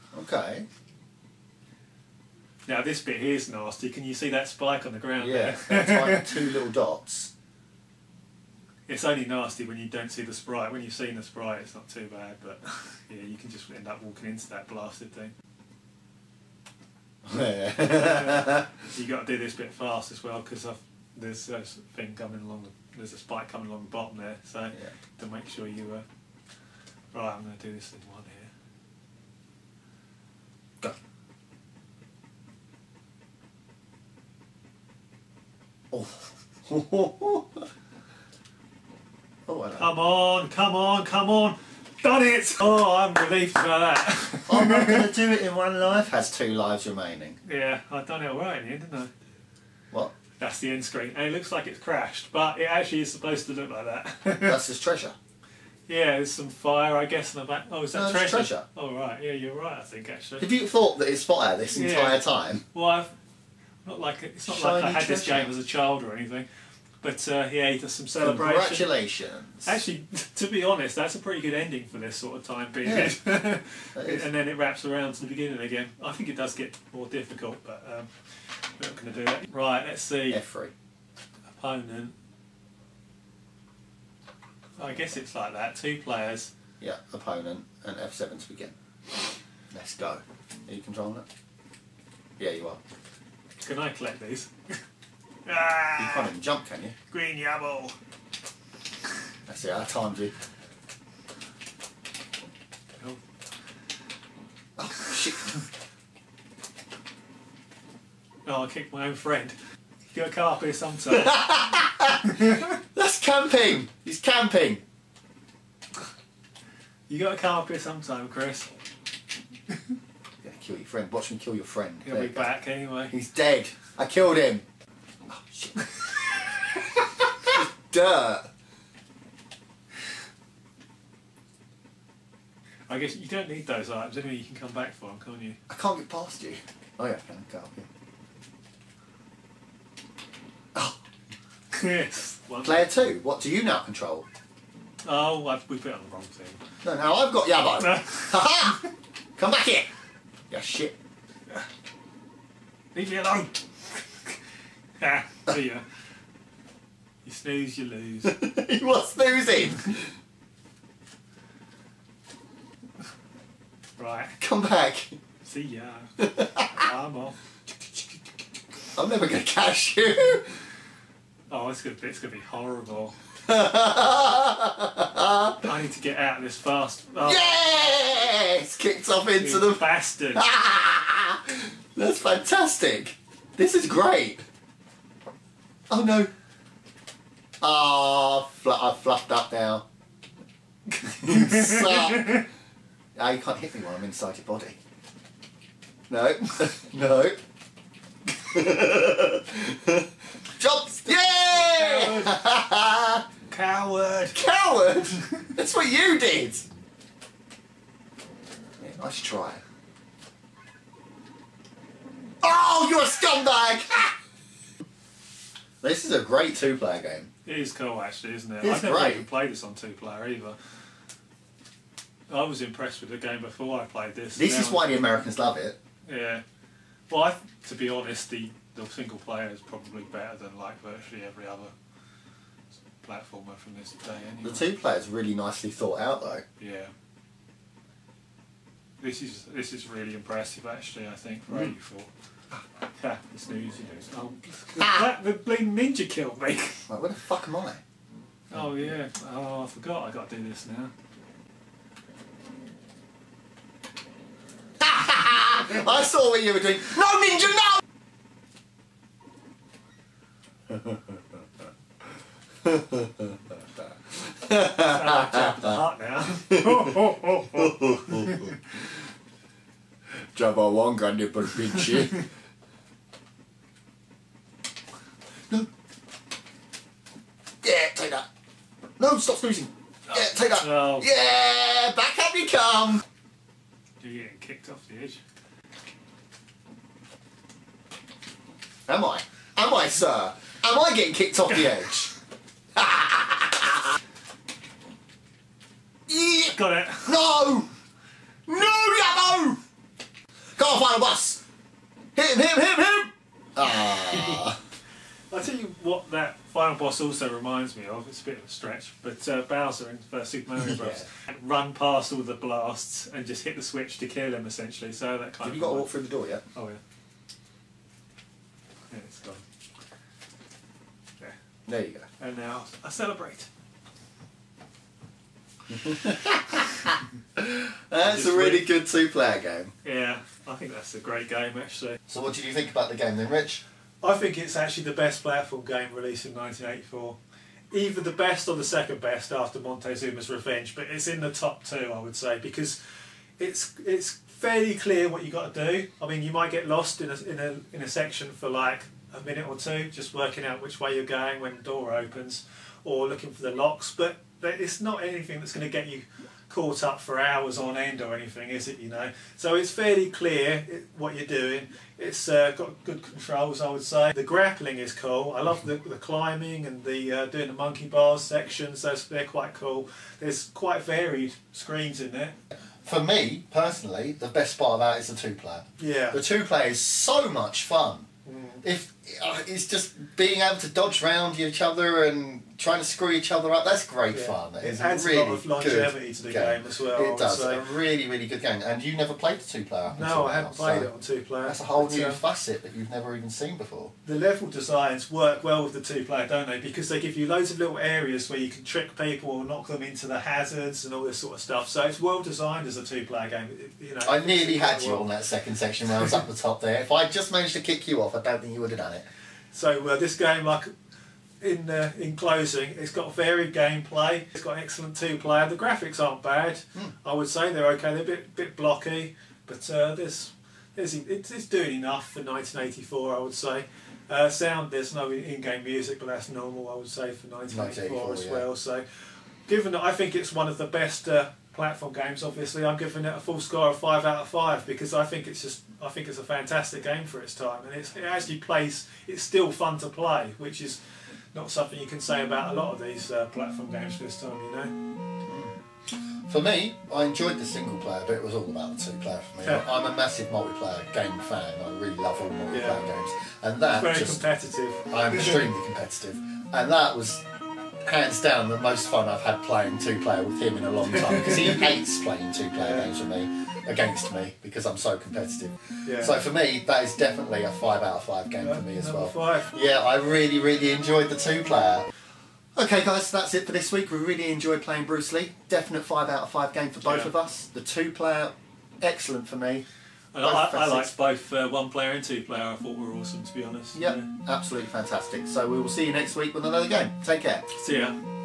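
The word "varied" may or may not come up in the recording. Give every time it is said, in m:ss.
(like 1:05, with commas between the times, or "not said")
6:10, 6:53.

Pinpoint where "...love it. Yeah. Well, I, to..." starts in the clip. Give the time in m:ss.
3:45.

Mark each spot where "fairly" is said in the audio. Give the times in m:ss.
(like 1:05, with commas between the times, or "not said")
5:44, 5:59.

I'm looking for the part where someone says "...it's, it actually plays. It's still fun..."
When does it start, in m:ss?
7:17.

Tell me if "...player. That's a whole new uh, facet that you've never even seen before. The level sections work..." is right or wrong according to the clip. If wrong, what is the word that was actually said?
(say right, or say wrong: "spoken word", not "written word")
wrong: "designs", not "sections".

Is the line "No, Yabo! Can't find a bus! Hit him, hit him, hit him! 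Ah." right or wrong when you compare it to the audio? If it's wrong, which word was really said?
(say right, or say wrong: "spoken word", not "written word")
right.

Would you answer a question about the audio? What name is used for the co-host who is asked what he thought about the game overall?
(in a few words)
Rich.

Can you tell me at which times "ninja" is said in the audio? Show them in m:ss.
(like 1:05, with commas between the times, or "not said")
4:05, 4:17.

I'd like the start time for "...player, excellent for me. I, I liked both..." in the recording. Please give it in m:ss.
7:57.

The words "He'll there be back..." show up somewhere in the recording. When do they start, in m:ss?
2:02.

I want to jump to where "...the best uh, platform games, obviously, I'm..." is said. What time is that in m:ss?
7:10.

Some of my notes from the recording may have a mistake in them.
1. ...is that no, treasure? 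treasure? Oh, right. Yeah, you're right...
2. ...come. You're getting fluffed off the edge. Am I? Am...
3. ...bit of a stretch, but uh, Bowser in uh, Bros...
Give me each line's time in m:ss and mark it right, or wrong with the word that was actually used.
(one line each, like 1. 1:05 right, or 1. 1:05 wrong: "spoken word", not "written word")
1. 0:57 right
2. 4:42 wrong: "kicked", not "fluffed"
3. 5:08 wrong: "Super", not "Bros".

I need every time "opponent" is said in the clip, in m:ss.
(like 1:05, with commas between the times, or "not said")
1:21, 1:27.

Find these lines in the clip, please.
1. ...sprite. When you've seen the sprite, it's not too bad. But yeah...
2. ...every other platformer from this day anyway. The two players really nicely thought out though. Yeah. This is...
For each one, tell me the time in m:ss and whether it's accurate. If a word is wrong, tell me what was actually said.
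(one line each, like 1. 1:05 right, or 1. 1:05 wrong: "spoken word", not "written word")
1. 0:10 right
2. 3:51 right.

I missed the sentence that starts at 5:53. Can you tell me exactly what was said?
But it's not anything that's going to get you caught up for hours on end or anything, is it?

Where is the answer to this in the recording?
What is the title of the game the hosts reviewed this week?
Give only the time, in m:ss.
7:54.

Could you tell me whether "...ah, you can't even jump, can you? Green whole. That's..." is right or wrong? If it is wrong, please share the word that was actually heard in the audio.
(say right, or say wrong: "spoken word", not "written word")
wrong: "yabble", not "whole".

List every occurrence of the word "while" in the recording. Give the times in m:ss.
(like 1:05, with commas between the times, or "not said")
3:13.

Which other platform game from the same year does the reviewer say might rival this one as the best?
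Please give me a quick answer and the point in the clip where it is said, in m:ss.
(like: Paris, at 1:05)
Montezuma's Revenge, at 5:39.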